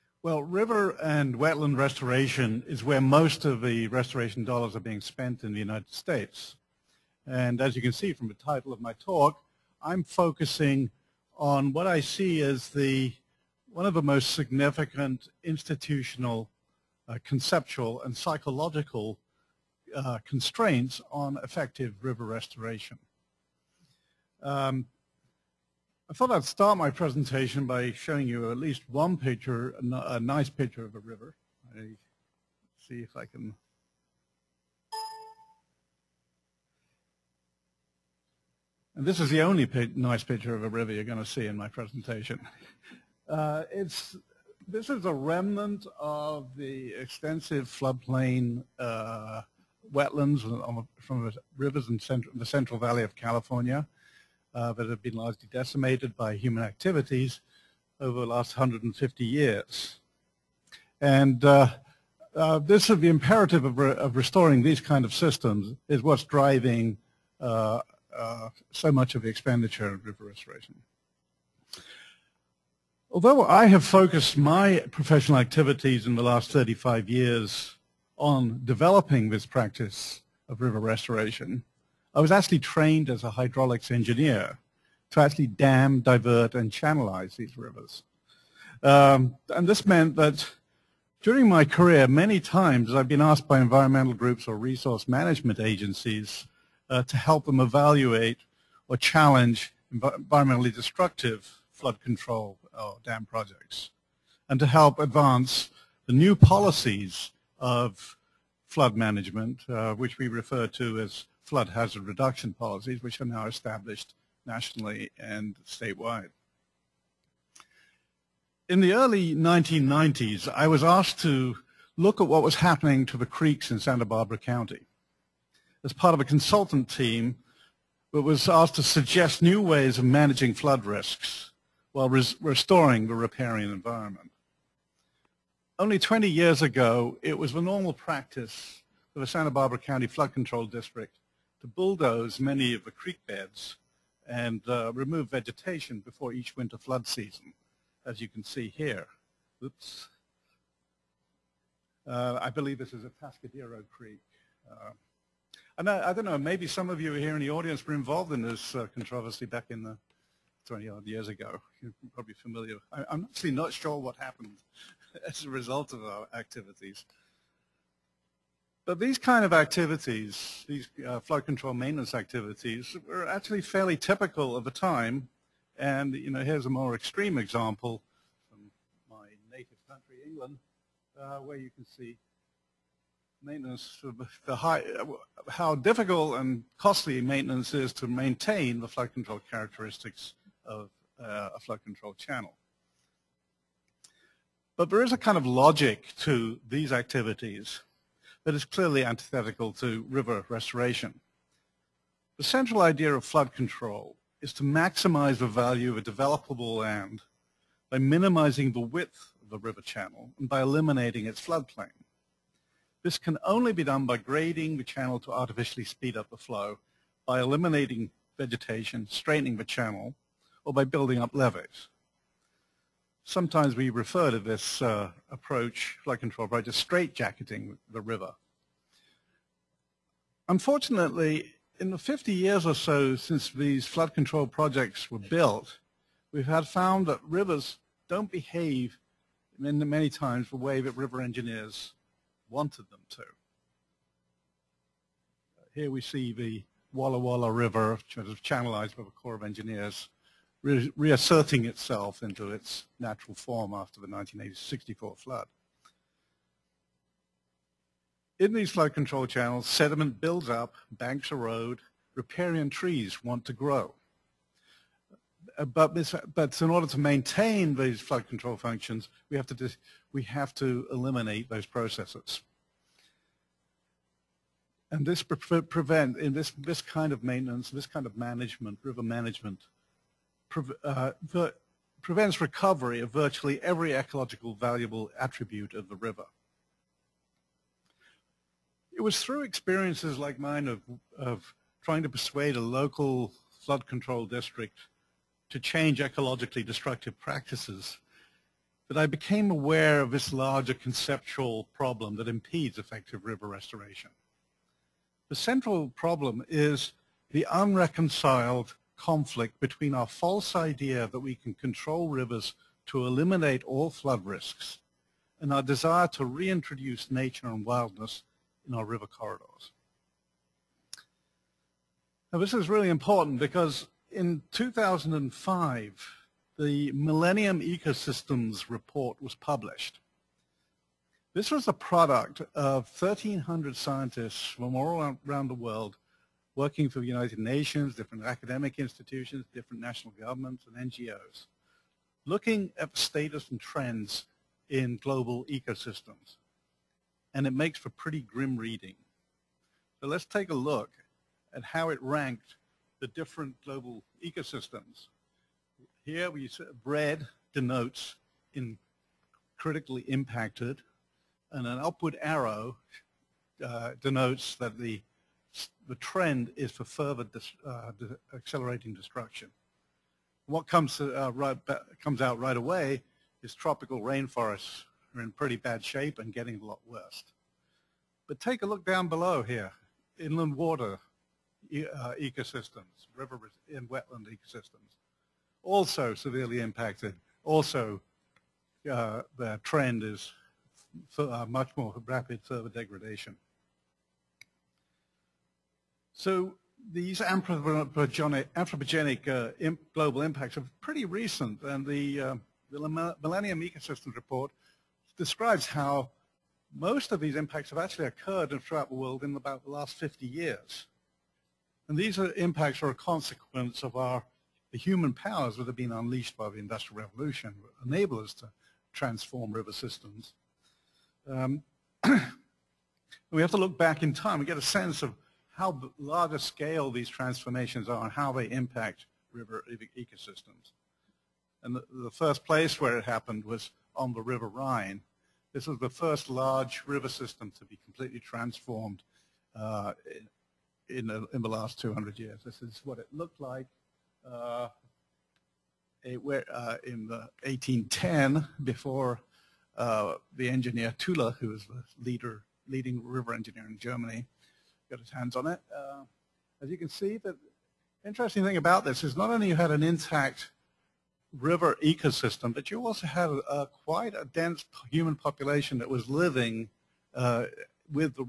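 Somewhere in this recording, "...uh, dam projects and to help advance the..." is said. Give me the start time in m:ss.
1:42.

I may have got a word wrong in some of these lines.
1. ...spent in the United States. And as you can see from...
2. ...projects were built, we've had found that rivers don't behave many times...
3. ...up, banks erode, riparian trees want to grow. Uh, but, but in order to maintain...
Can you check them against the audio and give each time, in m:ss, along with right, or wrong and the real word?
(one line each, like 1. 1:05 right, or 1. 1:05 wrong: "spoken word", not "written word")
1. 0:04 right
2. 3:54 right
3. 4:20 right.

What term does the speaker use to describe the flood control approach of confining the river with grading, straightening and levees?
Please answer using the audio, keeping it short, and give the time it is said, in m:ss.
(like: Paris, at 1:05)
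straightjacketing, at 3:46.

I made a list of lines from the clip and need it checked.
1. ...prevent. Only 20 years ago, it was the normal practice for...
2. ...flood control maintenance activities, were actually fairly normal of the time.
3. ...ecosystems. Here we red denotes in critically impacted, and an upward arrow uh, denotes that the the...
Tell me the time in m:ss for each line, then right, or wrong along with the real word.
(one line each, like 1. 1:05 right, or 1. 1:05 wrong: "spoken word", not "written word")
1. 2:13 wrong: "environment", not "prevent"
2. 2:51 wrong: "typical", not "normal"
3. 5:54 right.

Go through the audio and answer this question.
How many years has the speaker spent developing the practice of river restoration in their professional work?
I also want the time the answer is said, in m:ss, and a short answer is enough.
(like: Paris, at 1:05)
35 years, at 1:16.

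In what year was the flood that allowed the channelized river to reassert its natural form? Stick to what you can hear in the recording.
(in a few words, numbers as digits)
1964.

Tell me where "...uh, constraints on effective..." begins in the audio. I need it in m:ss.
0:19.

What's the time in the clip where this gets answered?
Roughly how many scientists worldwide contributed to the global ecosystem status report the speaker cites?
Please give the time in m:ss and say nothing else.
5:32.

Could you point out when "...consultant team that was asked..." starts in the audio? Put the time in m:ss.
2:06.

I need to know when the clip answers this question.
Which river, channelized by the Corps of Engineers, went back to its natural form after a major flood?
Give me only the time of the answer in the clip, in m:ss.
4:06.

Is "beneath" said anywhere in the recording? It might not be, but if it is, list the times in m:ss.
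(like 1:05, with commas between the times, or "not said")
not said.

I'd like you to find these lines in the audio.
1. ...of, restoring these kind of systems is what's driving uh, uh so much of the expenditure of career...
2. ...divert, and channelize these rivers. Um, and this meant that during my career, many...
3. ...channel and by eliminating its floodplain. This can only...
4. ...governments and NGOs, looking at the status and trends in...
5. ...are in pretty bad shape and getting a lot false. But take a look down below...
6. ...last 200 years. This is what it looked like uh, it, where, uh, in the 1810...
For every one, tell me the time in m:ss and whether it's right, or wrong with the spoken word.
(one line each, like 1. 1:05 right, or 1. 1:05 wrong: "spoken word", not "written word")
1. 1:03 wrong: "river", not "career"
2. 1:26 right
3. 3:29 right
4. 5:40 right
5. 6:15 wrong: "worse", not "false"
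6. 7:21 right.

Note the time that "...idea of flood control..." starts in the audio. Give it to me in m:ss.
3:22.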